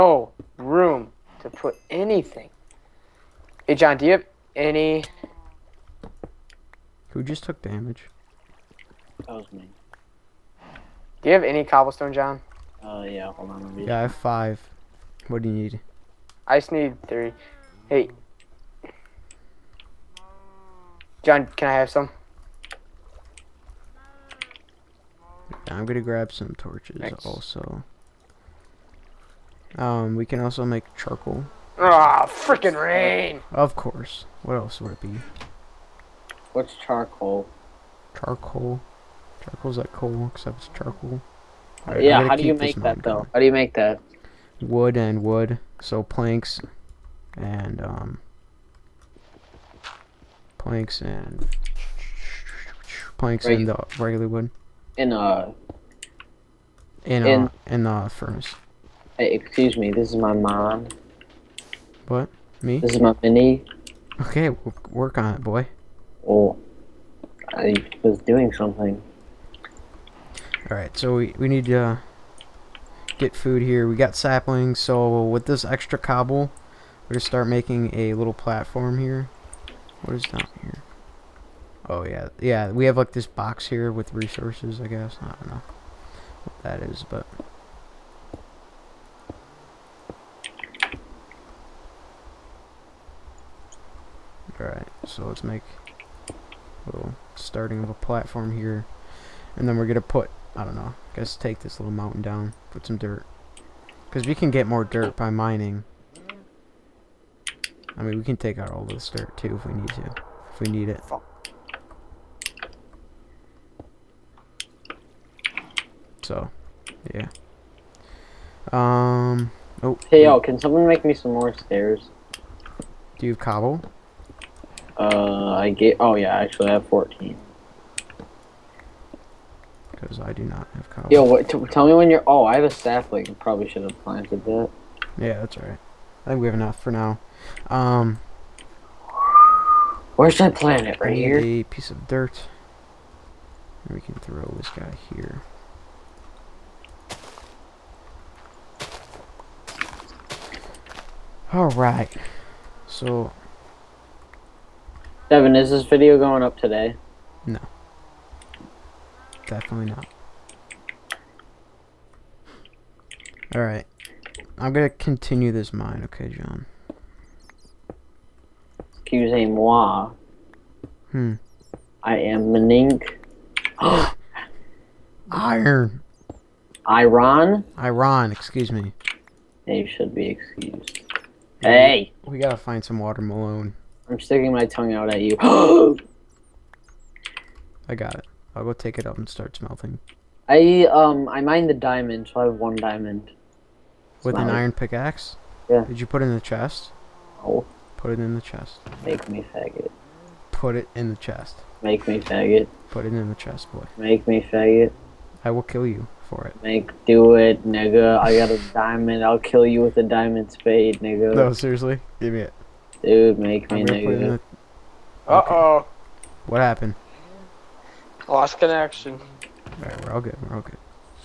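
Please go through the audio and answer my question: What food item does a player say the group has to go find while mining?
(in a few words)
Watermelon.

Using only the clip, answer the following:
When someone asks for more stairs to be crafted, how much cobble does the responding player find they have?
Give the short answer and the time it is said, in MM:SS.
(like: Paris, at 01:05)
14, at 02:06.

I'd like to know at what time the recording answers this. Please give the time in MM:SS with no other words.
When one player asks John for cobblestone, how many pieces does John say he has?
00:13.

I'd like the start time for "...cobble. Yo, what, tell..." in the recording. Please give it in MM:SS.
02:10.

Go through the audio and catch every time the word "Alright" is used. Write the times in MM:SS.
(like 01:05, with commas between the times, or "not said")
01:10, 01:34, 02:43, 03:39.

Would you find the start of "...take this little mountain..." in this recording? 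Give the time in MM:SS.
01:41.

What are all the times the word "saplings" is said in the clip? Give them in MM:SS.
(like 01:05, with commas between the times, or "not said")
01:14, 02:12.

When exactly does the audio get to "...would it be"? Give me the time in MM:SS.
00:34.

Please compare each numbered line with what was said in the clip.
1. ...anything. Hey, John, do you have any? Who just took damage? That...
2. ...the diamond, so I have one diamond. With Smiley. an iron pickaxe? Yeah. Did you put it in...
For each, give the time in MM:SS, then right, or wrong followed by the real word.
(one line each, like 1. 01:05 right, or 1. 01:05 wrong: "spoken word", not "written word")
1. 00:01 right
2. 03:11 right.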